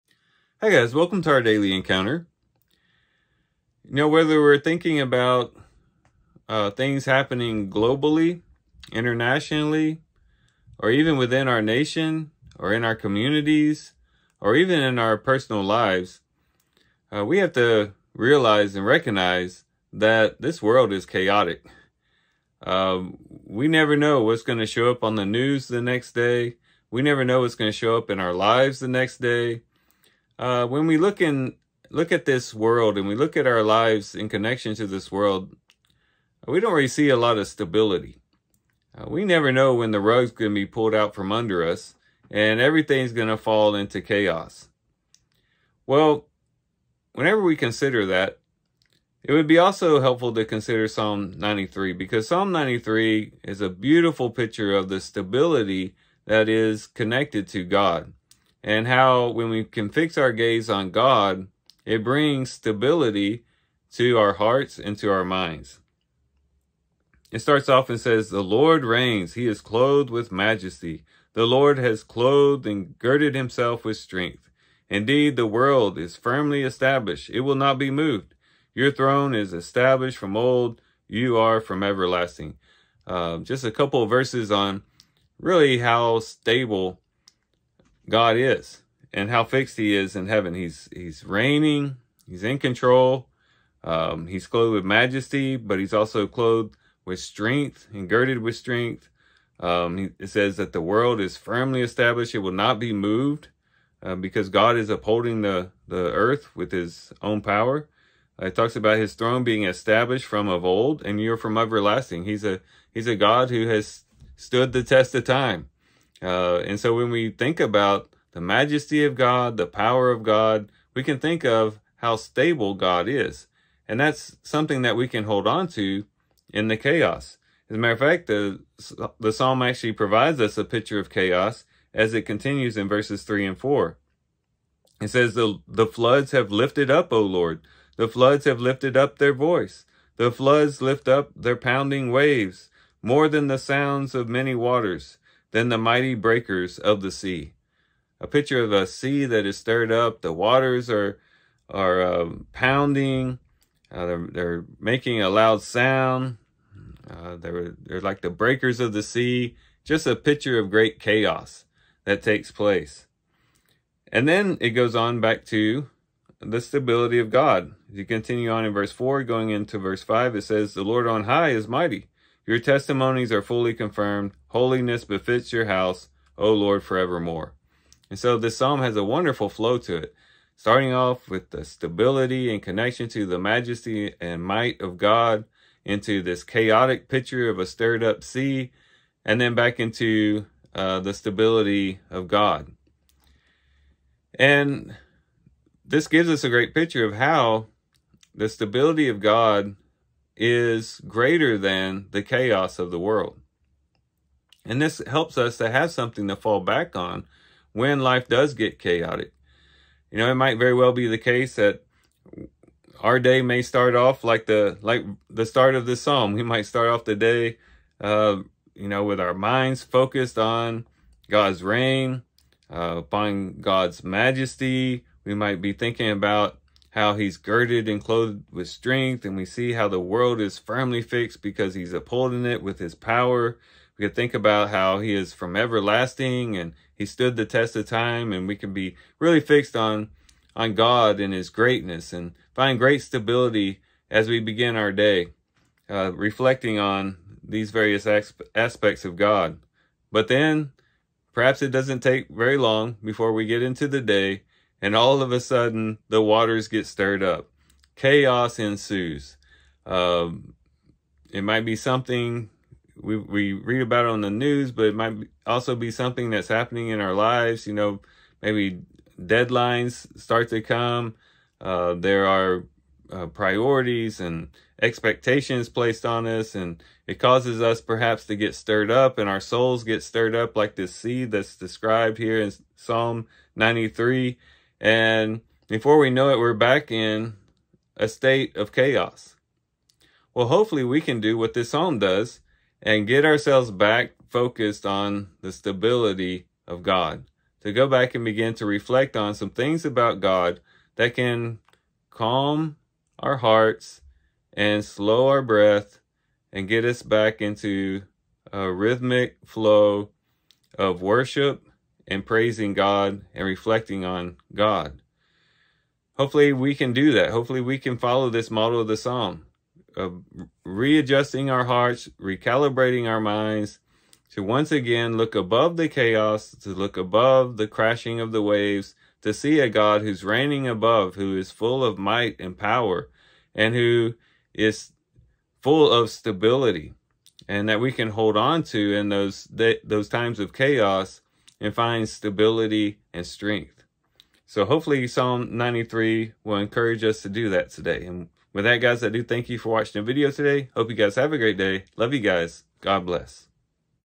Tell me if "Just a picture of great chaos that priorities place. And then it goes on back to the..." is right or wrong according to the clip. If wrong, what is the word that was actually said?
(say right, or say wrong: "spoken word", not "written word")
wrong: "takes", not "priorities".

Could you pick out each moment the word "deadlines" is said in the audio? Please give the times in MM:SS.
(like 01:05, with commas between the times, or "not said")
04:29.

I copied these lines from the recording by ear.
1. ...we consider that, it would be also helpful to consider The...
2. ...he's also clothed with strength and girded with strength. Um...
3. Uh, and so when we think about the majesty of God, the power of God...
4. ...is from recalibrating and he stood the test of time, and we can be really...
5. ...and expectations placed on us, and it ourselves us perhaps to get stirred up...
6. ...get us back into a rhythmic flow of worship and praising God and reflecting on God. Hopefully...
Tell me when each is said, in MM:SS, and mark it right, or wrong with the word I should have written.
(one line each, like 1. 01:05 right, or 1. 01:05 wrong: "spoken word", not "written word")
1. 00:47 wrong: "Psalm", not "The"
2. 01:35 right
3. 01:56 right
4. 03:55 wrong: "everlasting", not "recalibrating"
5. 04:34 wrong: "causes", not "ourselves"
6. 05:06 right.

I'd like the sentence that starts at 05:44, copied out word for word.
So hopefully Psalm 93 will encourage us to do that today.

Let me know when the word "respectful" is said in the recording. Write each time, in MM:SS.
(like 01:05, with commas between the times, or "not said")
not said.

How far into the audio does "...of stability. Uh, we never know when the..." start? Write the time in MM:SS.
00:37.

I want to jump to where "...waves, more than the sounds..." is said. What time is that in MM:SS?
02:22.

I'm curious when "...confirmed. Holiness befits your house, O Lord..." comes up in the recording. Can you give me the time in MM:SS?
02:53.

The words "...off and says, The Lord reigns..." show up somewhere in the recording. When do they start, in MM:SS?
01:07.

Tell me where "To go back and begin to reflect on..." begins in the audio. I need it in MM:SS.
04:57.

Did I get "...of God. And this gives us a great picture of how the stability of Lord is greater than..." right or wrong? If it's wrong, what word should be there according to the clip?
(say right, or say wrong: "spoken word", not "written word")
wrong: "God", not "Lord".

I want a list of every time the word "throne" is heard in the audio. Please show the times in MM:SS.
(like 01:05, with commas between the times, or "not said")
01:18, 01:49.